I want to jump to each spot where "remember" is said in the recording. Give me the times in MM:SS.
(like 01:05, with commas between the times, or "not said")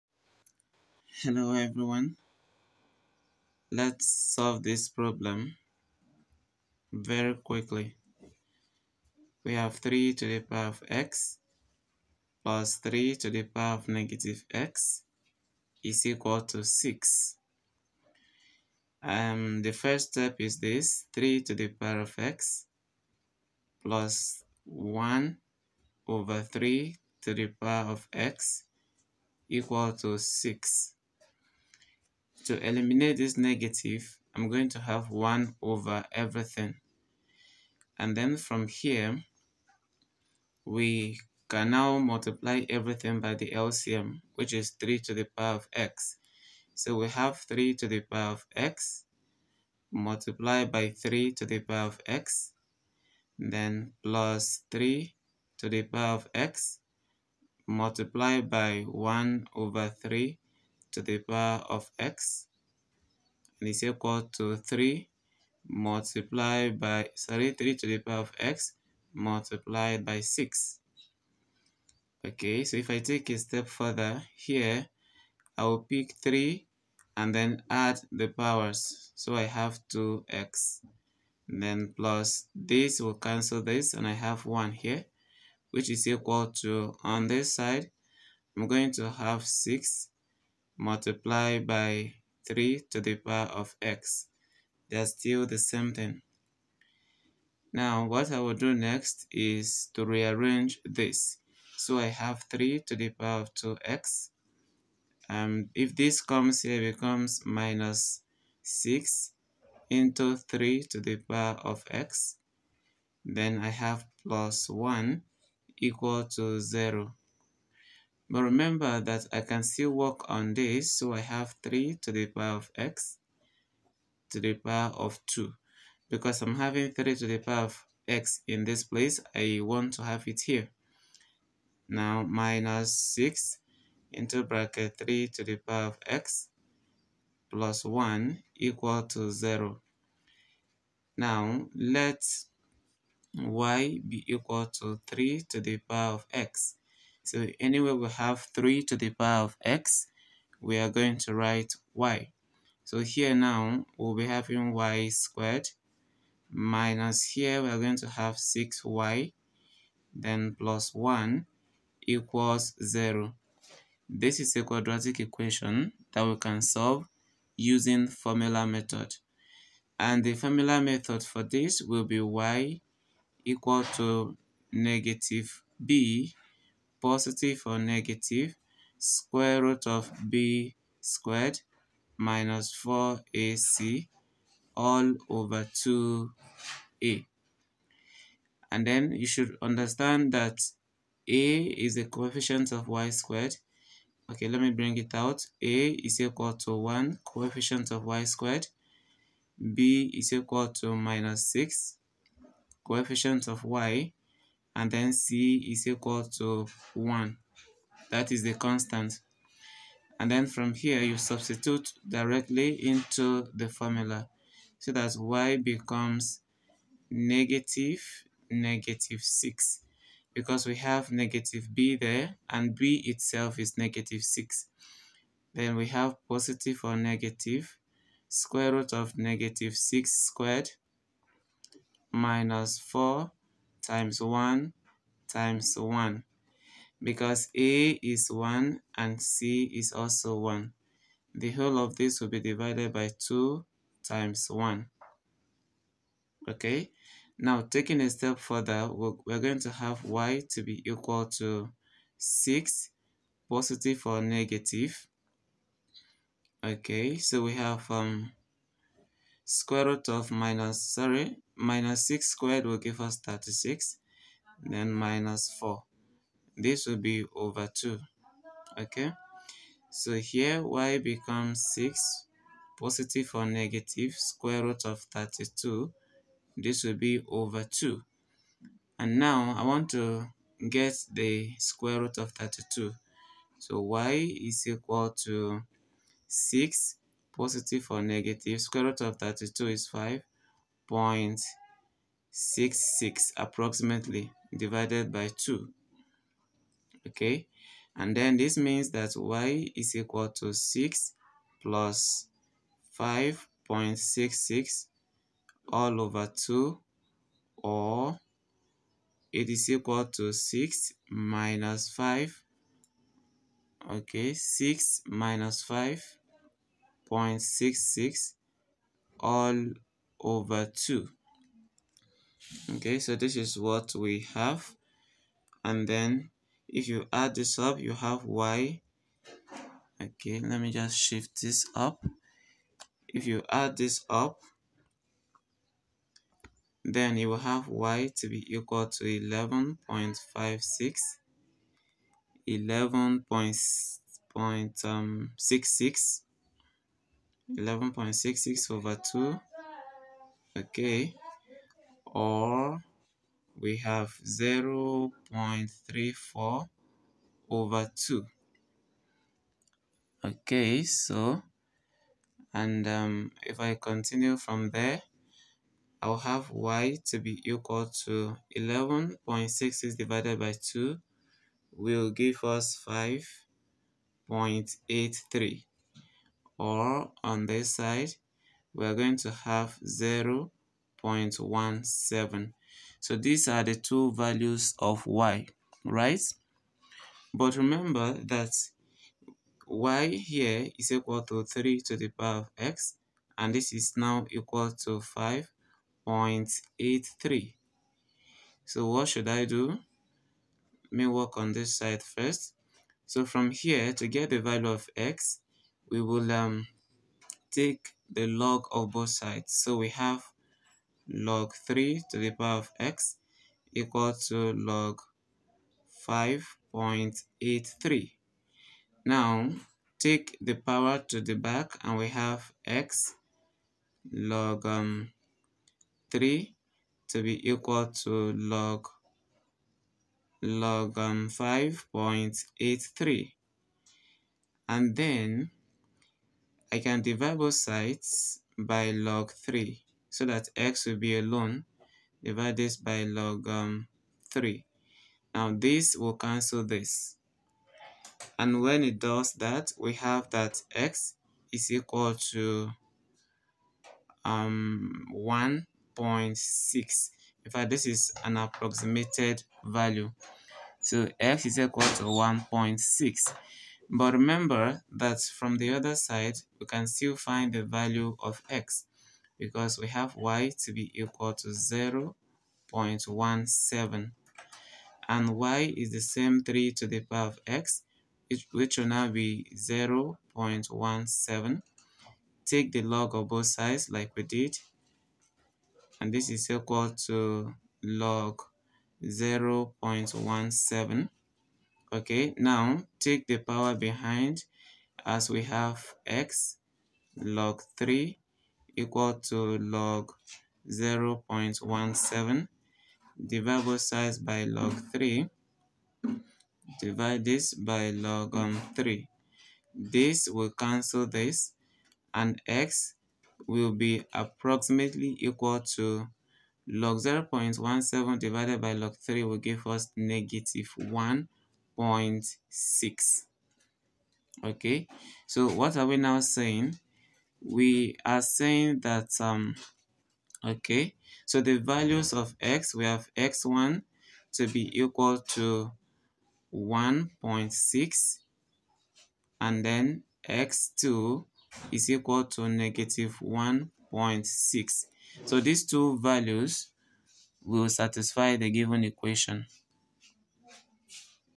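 01:58, 06:27, 07:44.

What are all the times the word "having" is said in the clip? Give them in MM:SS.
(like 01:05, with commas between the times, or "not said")
02:06, 02:34.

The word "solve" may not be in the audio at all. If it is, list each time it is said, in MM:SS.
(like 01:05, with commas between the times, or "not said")
00:04, 02:46.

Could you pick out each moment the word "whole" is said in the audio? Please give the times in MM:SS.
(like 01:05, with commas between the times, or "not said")
04:01.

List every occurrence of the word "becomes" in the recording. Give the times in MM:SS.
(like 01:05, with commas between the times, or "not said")
01:46, 03:35, 04:30.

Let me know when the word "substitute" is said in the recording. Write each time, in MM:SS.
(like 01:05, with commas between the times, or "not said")
03:31.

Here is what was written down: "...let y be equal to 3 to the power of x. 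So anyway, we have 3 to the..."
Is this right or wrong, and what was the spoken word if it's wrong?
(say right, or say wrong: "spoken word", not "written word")
right.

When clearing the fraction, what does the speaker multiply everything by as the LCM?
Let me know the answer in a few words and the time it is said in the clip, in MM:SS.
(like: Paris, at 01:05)
3 to the power of x, at 00:44.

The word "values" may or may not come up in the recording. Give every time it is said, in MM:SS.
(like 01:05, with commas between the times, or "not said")
06:24, 06:44, 07:39, 07:47, 08:51, 09:05.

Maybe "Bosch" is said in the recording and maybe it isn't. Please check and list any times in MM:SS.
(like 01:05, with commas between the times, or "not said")
not said.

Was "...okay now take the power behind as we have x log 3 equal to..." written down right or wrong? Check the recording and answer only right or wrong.
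right.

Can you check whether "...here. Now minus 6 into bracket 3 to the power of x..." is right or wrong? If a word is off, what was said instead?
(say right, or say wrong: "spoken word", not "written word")
right.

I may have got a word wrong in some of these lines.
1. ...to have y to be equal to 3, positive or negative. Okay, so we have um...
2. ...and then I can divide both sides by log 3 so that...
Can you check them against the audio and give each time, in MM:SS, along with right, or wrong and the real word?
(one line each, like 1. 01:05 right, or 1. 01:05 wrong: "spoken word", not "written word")
1. 04:09 wrong: "6", not "3"
2. 07:14 right.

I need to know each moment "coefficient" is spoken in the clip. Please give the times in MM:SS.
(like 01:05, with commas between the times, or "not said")
03:12, 03:17, 03:22.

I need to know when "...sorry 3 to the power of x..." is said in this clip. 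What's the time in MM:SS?
01:07.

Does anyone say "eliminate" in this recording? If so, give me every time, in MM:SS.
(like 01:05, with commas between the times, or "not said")
00:32.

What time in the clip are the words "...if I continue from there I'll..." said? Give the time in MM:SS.
06:03.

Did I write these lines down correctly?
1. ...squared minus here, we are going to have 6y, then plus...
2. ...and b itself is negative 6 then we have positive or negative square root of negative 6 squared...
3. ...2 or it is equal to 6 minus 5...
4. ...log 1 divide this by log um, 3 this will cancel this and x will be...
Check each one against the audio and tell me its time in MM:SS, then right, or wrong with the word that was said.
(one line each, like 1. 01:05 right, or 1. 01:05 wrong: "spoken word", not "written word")
1. 02:35 right
2. 03:42 right
3. 05:06 right
4. 08:24 wrong: "3", not "1".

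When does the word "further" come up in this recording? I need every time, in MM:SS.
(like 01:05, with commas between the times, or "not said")
01:13, 04:08.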